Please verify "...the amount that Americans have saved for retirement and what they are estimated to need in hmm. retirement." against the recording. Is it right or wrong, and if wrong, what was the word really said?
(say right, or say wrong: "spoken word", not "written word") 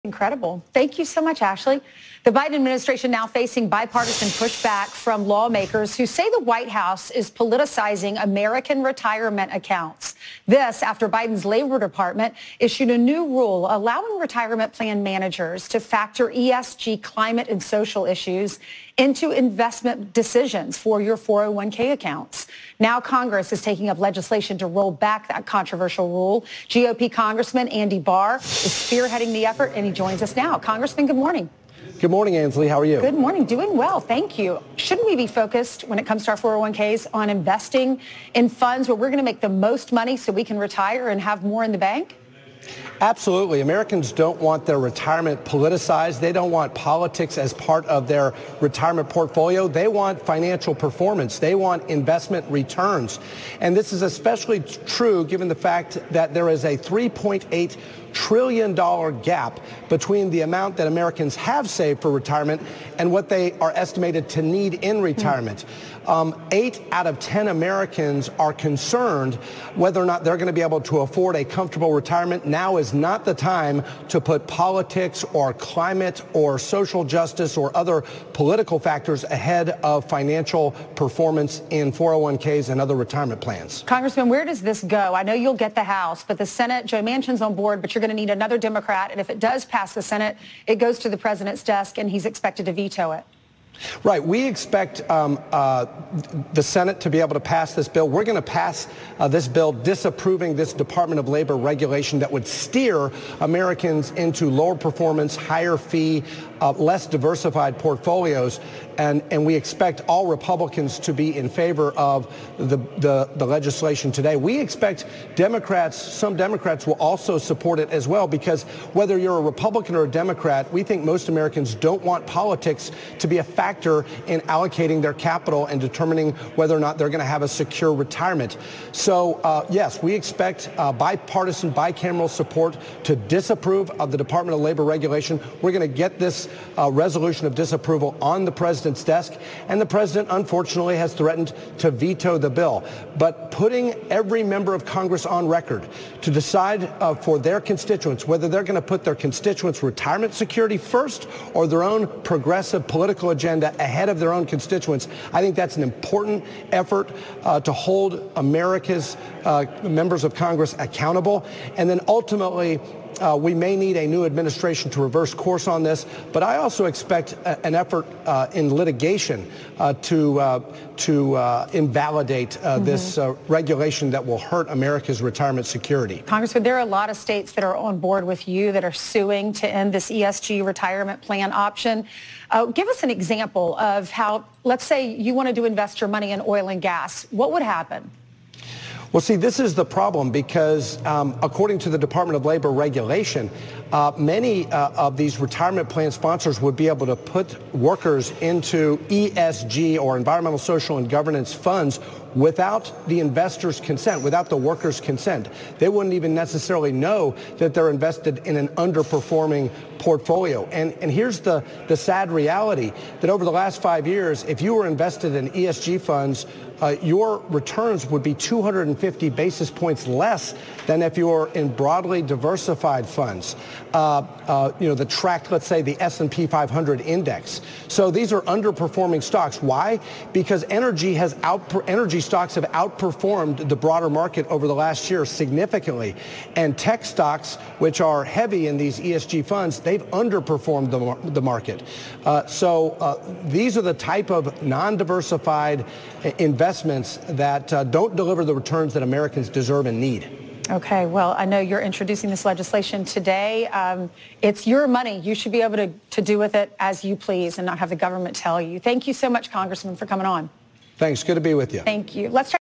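right.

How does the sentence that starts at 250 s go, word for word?
Okay, well, I know you're introducing this legislation today.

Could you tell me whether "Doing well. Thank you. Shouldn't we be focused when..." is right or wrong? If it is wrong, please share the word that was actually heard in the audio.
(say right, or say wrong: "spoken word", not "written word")
right.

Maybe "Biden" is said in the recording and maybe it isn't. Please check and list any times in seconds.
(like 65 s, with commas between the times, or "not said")
2 s, 11 s.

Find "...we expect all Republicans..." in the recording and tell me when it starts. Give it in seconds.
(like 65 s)
109 s.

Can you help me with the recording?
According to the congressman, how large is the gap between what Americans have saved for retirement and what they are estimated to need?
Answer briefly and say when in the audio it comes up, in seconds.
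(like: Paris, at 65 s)
$3.8 trillion, at 56 s.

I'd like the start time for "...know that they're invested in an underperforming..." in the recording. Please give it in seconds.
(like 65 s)
206 s.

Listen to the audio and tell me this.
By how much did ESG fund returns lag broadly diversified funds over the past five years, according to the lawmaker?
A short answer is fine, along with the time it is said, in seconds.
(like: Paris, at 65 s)
250 basis points, at 218 s.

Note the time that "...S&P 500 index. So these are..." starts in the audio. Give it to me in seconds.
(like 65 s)
226 s.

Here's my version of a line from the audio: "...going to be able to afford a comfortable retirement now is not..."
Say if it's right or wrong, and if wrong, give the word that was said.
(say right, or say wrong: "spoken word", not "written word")
right.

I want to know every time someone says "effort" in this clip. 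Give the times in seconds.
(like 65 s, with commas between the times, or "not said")
29 s, 156 s, 167 s.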